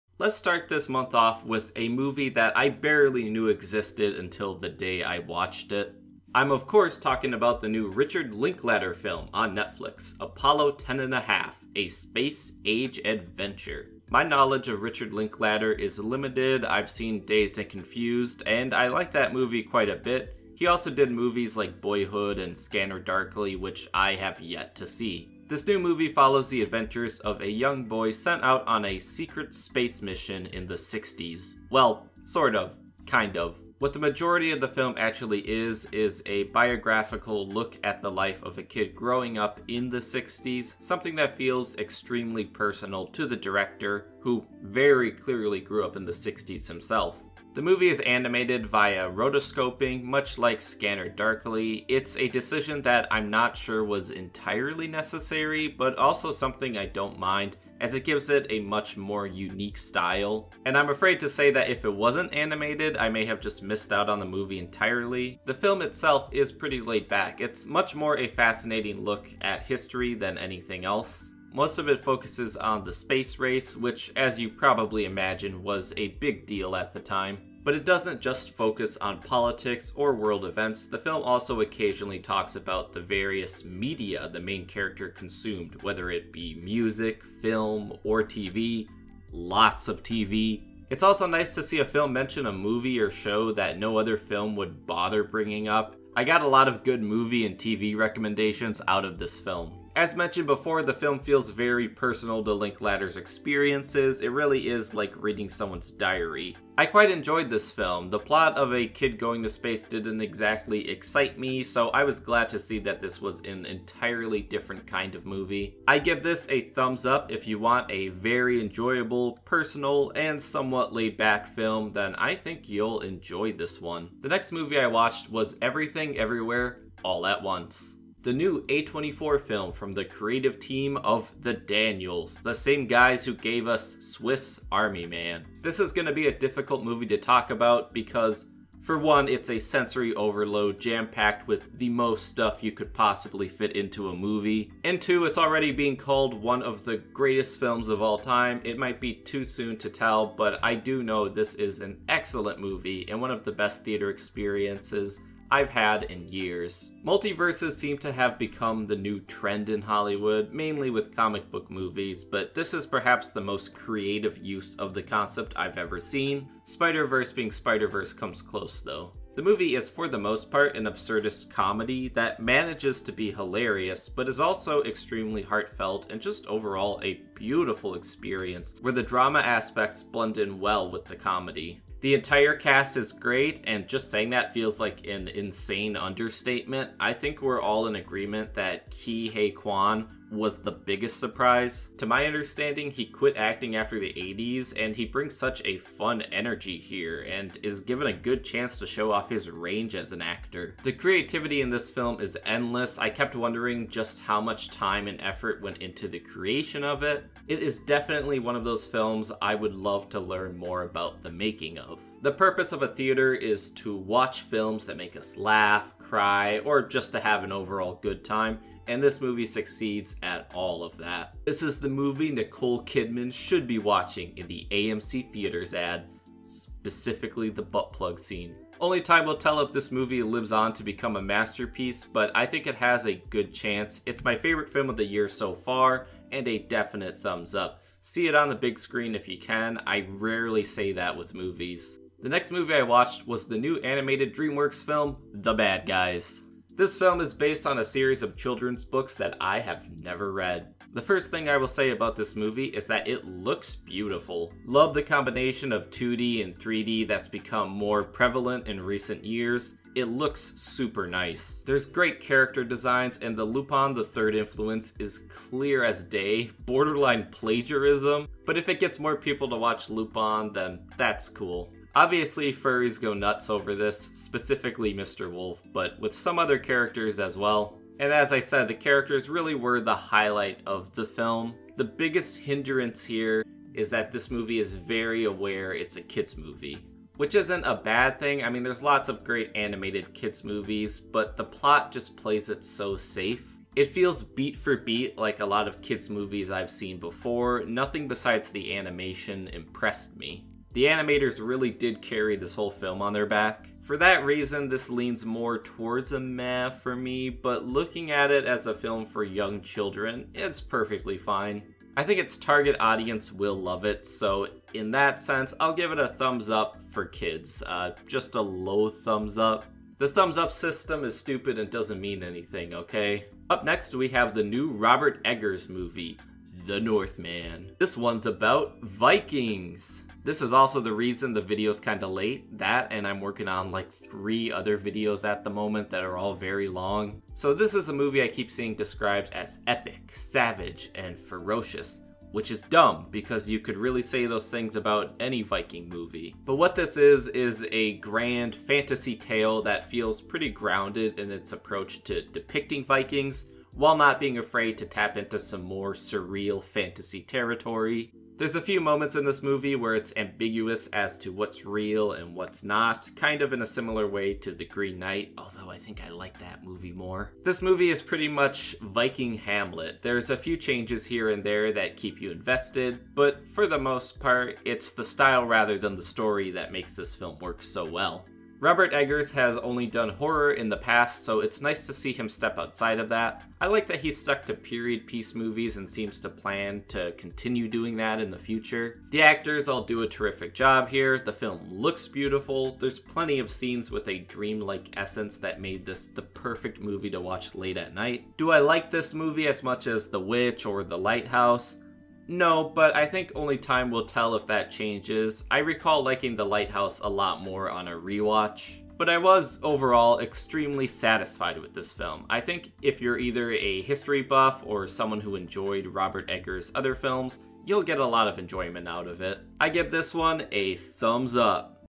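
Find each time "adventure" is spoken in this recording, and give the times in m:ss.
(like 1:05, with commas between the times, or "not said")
0:13, 0:26.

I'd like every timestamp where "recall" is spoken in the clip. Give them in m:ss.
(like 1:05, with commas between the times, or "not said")
6:45.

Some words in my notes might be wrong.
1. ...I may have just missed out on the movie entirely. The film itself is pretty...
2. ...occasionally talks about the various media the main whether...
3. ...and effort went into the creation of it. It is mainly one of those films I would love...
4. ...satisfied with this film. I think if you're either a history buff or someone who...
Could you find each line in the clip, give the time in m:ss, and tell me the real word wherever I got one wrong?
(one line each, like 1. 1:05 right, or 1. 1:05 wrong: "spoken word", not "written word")
1. 1:02 right
2. 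1:21 wrong: "character", not "whether"
3. 3:25 wrong: "definitely", not "mainly"
4. 6:50 right.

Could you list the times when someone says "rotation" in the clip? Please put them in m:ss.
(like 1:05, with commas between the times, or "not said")
not said.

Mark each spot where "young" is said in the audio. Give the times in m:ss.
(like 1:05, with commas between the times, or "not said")
0:27, 5:09.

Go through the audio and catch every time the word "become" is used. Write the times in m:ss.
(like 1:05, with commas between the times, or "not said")
2:38, 3:50, 4:17.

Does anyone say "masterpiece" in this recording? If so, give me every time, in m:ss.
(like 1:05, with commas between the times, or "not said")
3:51.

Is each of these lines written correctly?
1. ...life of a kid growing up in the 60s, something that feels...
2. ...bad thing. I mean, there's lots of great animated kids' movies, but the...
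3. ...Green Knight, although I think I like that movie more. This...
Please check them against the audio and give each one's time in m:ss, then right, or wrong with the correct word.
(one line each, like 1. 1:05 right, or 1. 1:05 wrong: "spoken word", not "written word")
1. 0:38 right
2. 4:47 right
3. 6:04 right.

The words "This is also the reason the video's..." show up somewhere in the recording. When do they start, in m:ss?
5:30.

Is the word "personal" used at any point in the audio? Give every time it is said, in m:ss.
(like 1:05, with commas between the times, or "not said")
0:42, 1:41, 1:59.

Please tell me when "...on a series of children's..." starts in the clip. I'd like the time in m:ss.
4:07.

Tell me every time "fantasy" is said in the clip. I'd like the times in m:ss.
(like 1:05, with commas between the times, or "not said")
5:48, 5:56.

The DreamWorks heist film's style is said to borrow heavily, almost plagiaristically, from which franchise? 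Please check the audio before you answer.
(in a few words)
Lupin the Third.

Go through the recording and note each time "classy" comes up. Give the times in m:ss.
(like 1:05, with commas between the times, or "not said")
not said.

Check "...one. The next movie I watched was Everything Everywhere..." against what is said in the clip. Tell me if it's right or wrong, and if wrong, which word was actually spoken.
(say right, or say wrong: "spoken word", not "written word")
right.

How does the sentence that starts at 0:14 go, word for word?
My knowledge of Richard Linklater is limited.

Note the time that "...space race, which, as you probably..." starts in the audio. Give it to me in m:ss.
1:12.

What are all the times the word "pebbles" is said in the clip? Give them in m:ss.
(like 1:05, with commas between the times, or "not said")
not said.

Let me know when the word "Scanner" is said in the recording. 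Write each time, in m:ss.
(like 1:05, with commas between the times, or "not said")
0:22, 0:50.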